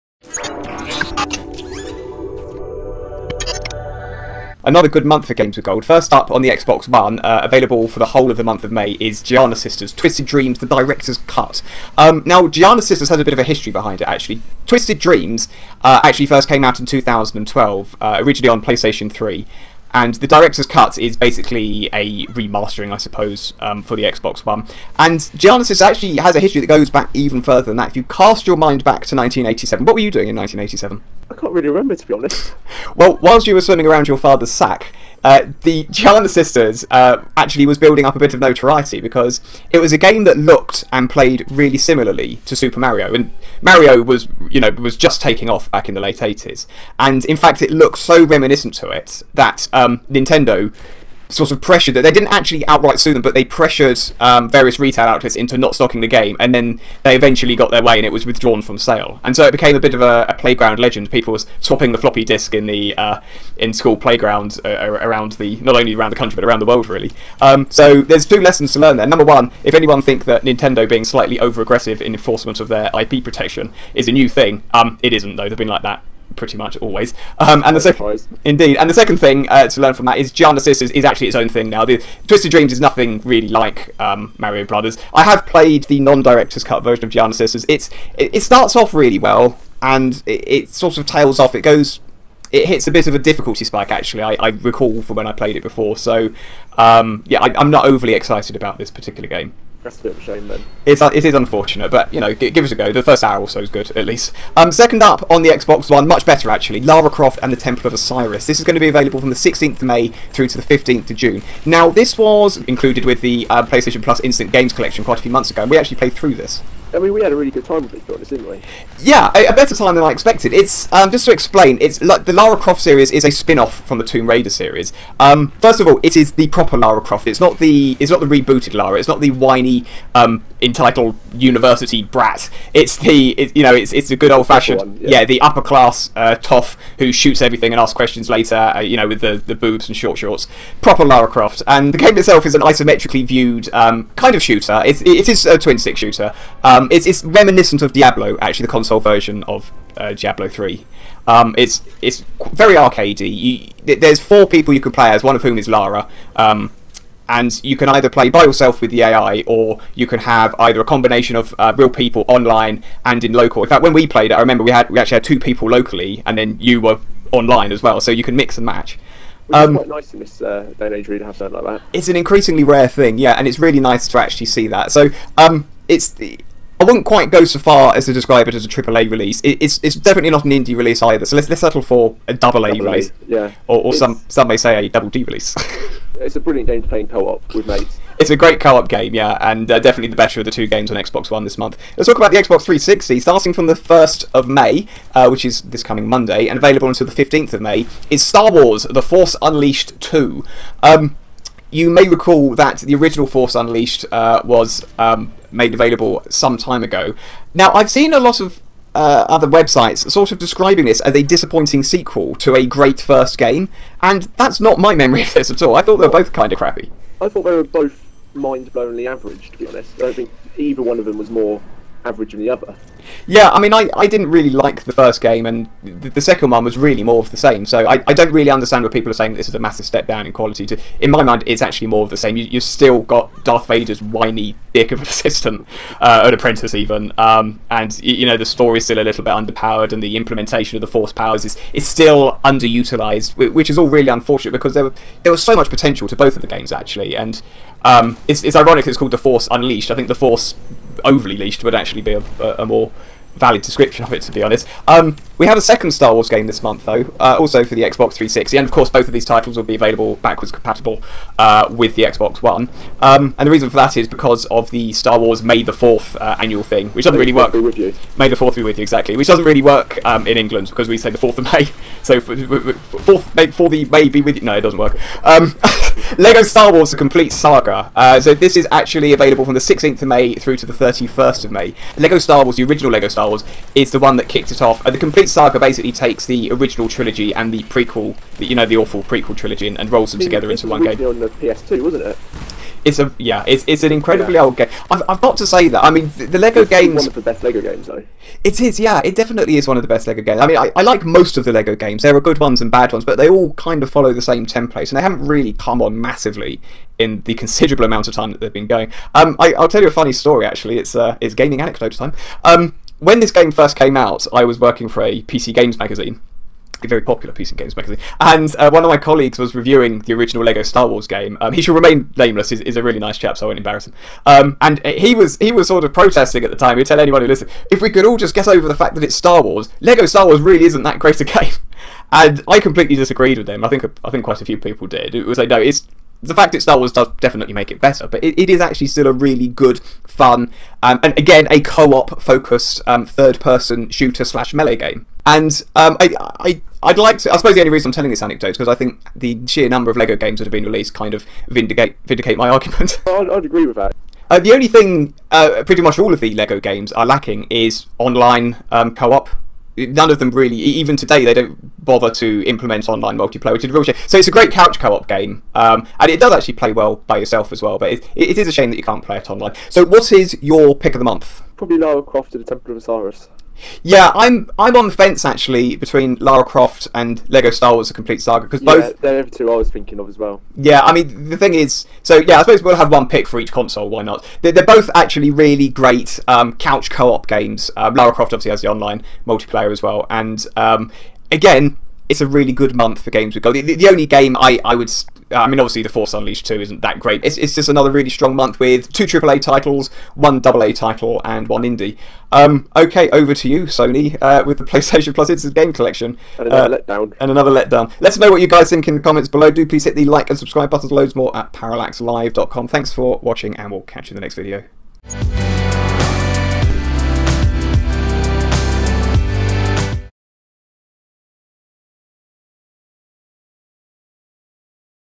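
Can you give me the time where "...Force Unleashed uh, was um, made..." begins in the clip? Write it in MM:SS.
03:23.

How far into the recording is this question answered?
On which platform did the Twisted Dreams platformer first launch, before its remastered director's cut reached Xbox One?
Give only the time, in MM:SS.
00:18.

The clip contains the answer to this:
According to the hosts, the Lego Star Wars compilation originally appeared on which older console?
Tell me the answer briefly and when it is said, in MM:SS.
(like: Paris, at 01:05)
PS2, at 04:51.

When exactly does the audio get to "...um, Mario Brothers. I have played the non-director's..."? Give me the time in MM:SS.
01:23.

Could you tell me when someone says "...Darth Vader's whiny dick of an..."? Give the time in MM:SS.
03:53.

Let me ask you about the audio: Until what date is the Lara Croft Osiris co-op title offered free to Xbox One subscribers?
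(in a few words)
15th of June.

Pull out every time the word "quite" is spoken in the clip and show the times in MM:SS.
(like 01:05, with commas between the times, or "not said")
01:55, 02:49, 02:57, 05:34.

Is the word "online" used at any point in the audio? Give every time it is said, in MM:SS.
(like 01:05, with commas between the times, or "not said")
02:42, 02:47, 05:57, 06:02, 06:09, 06:28.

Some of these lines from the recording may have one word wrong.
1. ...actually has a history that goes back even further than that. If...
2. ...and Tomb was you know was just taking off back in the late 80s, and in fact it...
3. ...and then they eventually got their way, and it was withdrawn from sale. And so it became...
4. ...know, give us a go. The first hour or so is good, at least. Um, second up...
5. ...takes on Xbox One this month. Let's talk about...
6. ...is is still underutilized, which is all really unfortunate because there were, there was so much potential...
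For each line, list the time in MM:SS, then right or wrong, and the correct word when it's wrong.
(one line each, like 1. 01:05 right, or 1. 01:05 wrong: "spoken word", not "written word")
1. 00:25 right
2. 00:43 wrong: "Mario", not "Tomb"
3. 00:56 right
4. 01:42 right
5. 03:10 wrong: "games", not "takes"
6. 04:01 right.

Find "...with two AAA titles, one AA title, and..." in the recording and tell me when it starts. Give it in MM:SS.
06:38.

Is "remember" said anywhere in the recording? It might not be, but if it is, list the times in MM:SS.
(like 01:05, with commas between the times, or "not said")
00:31, 02:44.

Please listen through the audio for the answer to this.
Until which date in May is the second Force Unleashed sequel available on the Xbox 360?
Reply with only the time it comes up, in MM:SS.
03:17.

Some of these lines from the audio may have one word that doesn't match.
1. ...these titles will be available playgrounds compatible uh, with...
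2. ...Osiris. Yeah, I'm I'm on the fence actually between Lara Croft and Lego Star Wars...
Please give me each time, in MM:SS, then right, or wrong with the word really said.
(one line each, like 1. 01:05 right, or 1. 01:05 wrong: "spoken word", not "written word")
1. 04:19 wrong: "backwards", not "playgrounds"
2. 06:12 right.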